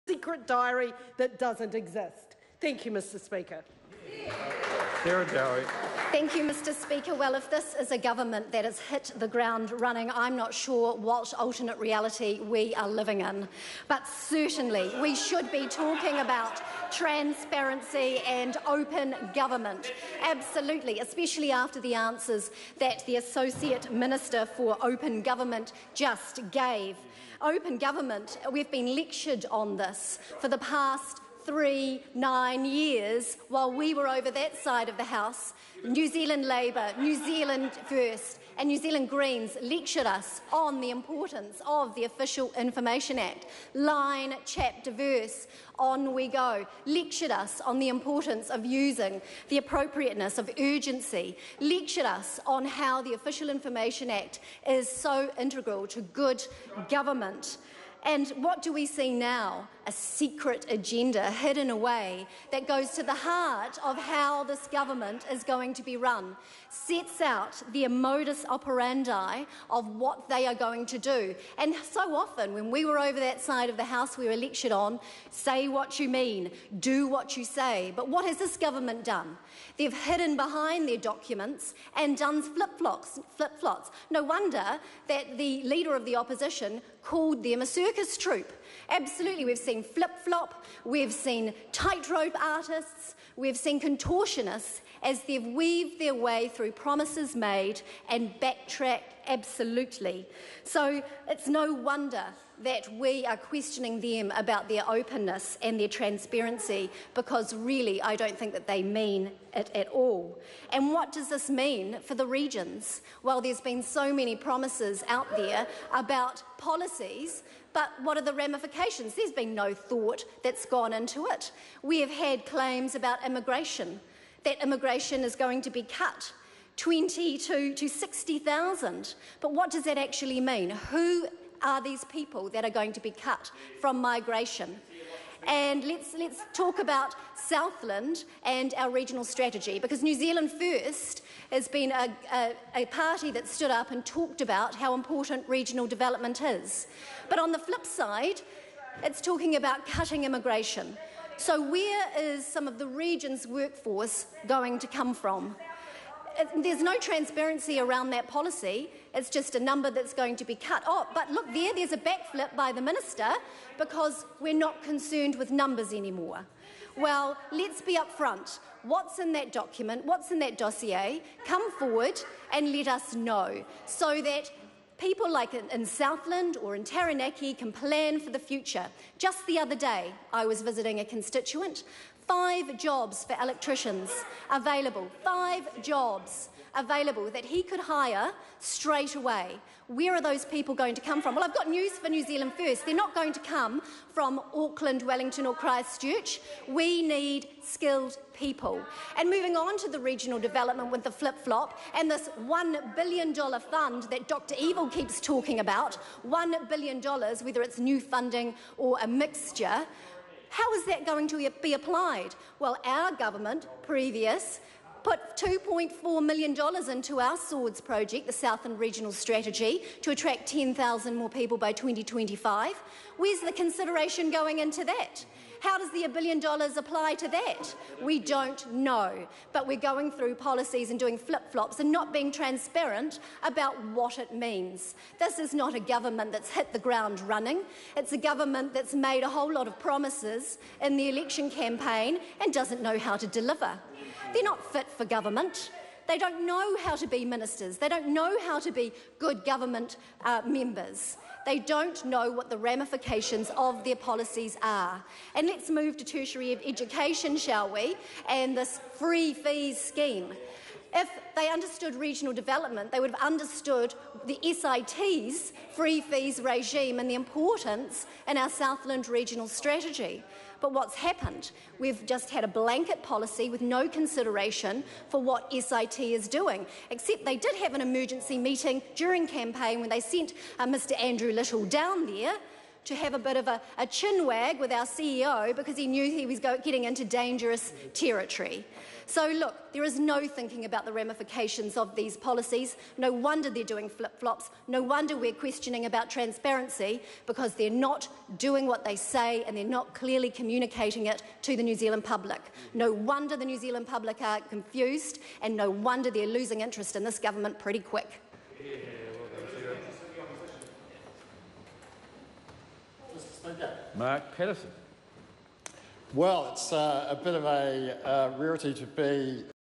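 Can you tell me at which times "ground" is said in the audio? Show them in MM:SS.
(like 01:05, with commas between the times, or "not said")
00:09, 03:56.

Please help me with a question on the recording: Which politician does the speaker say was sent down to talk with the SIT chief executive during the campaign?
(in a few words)
Andrew Little.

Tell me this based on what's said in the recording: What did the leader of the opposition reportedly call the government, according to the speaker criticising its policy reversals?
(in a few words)
circus troupe.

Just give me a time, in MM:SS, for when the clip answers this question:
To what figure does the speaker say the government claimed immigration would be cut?
02:07.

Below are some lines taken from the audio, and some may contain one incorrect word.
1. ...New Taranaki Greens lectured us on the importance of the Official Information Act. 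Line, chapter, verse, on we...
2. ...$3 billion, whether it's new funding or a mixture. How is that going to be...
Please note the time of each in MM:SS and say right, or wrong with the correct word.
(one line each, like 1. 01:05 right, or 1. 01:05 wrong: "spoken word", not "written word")
1. 00:38 wrong: "Zealand", not "Taranaki"
2. 03:26 wrong: "1", not "3".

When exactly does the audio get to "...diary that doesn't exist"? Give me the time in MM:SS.
00:00.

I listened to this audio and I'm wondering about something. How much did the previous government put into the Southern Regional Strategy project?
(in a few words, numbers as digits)
$2.4 million.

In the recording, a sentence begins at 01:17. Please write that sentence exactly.
But what has this government done?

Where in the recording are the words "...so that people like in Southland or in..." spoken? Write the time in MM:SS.
02:53.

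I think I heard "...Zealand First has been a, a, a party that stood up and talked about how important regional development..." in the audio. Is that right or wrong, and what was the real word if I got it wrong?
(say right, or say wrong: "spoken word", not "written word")
right.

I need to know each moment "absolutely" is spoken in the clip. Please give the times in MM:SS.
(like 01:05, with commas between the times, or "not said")
00:20, 01:28, 01:39.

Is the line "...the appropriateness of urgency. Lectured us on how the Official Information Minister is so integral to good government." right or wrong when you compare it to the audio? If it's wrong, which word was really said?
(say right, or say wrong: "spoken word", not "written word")
wrong: "Act", not "Minister".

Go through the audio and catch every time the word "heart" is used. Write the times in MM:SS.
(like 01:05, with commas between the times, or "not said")
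01:03.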